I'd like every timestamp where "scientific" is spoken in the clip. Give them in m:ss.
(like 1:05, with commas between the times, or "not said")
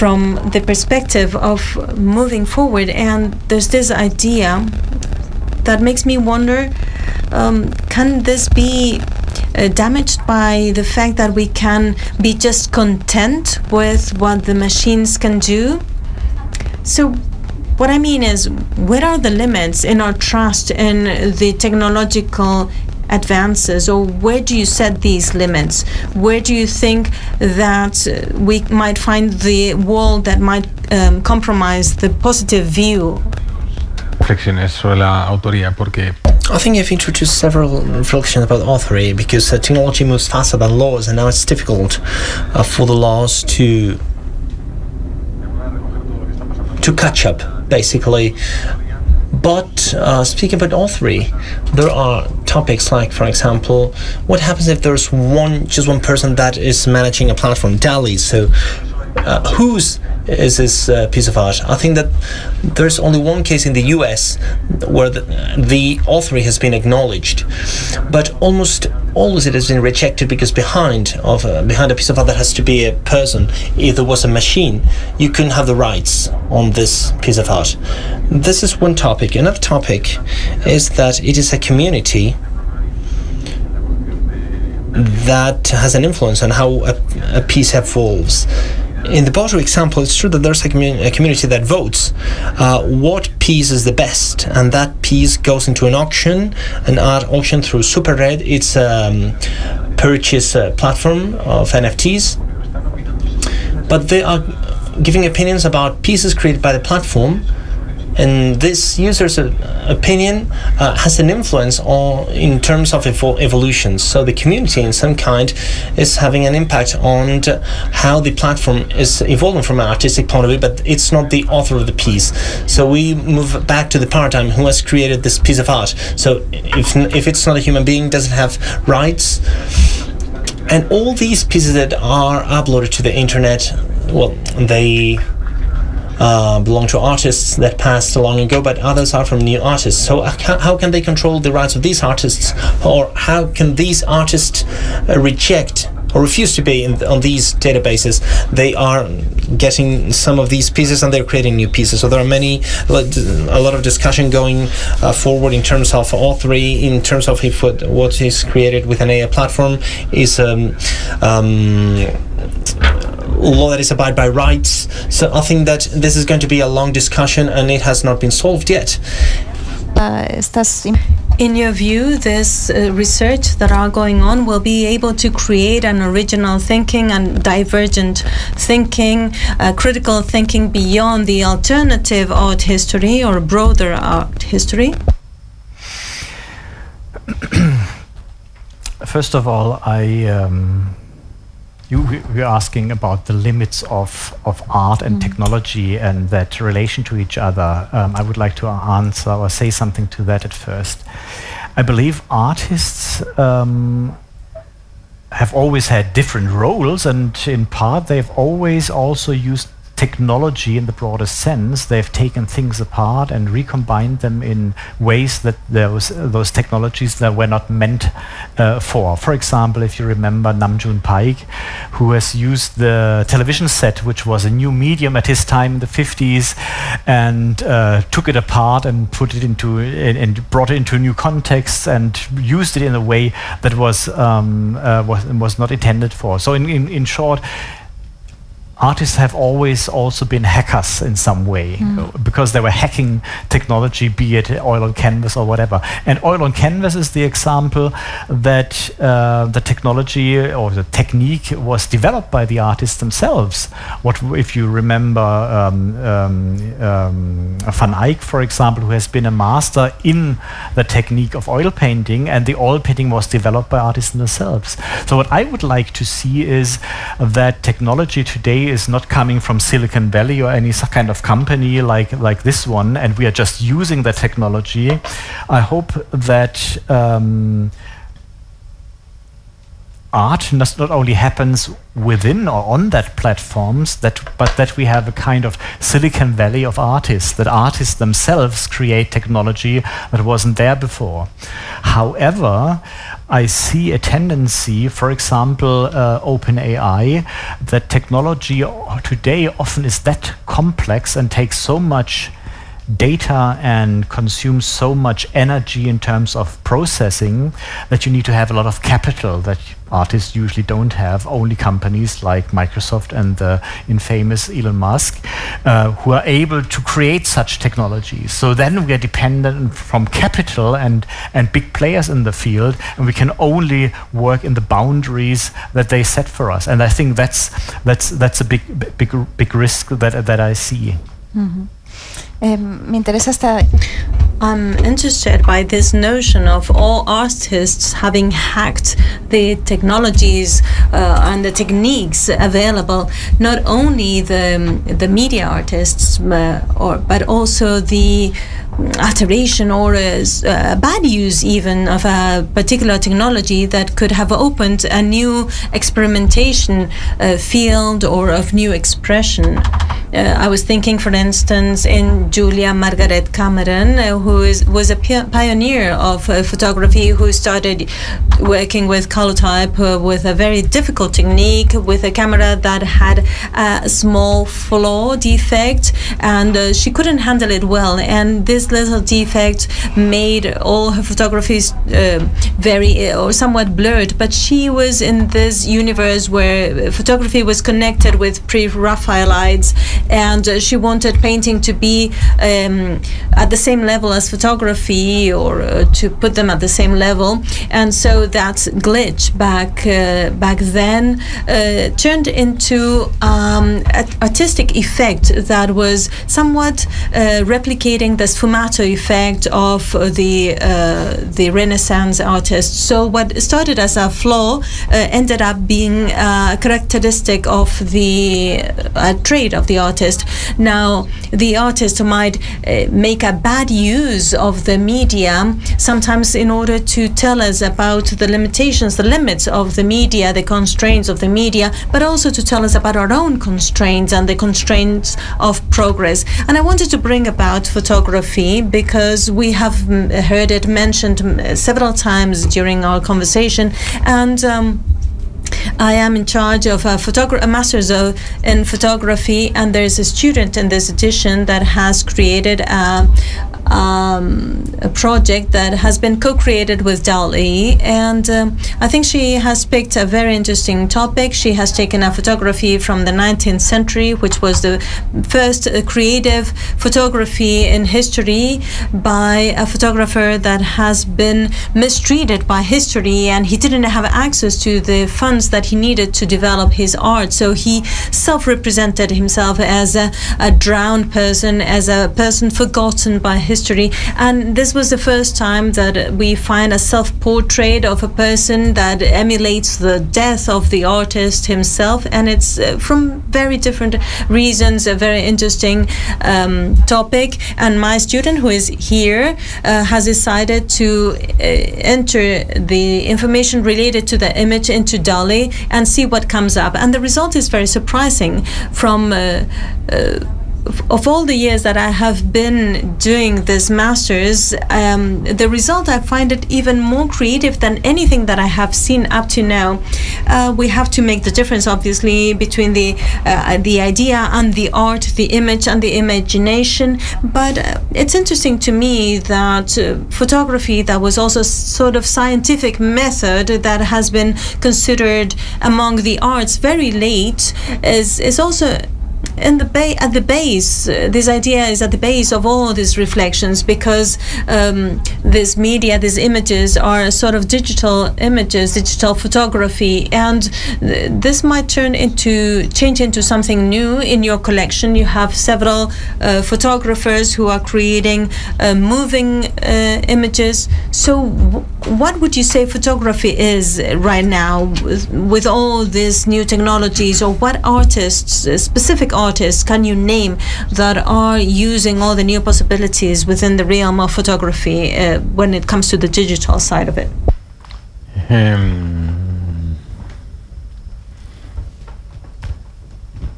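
8:52.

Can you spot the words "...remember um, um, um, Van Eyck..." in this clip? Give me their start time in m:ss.
4:14.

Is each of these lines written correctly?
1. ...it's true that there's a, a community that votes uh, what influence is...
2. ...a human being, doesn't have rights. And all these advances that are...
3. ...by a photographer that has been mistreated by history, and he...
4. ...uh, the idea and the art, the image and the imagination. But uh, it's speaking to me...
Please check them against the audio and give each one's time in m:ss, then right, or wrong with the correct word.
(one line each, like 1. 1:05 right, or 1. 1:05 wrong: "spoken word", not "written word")
1. 1:30 wrong: "piece", not "influence"
2. 2:07 wrong: "pieces", not "advances"
3. 7:48 right
4. 8:43 wrong: "interesting", not "speaking".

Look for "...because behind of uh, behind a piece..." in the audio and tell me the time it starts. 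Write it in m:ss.
1:10.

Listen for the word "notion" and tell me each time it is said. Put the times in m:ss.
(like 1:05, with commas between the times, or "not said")
5:35.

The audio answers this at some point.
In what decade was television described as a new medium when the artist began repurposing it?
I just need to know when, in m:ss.
3:45.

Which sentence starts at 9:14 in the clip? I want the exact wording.
You have several uh, photographers who are creating uh, moving uh, images.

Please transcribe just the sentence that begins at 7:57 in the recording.
So he self represented himself as a, a drowned person, as a person forgotten by history.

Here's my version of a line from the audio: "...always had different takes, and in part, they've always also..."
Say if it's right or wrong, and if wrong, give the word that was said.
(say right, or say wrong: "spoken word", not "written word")
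wrong: "roles", not "takes".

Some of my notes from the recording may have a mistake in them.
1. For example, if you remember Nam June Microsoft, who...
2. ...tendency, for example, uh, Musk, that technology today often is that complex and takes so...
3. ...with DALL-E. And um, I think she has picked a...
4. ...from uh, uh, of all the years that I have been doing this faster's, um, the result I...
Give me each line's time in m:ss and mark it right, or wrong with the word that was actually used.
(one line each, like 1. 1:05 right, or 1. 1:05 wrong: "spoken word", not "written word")
1. 3:39 wrong: "Paik", not "Microsoft"
2. 4:53 wrong: "OpenAI", not "Musk"
3. 7:36 right
4. 8:28 wrong: "master", not "faster".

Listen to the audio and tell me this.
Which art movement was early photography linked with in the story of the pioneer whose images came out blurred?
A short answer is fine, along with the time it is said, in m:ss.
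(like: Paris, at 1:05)
Pre-Raphaelites, at 6:28.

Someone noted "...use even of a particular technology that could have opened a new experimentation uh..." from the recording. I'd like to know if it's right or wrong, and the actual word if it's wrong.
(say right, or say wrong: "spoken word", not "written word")
right.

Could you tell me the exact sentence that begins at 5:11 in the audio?
Only companies like Microsoft and the infamous Elon Musk uh, who are able to create such technologies.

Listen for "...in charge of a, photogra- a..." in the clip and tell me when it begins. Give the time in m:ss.
7:26.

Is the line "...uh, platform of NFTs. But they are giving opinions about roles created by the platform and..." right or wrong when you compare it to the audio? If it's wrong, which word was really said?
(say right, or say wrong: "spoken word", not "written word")
wrong: "pieces", not "roles".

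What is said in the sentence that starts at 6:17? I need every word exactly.
And this this little defect made all her photographies uh, very or somewhat blurred.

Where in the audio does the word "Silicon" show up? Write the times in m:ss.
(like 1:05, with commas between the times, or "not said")
4:29, 4:45.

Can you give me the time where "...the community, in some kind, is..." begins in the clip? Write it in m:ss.
1:54.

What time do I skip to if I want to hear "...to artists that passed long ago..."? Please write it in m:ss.
2:16.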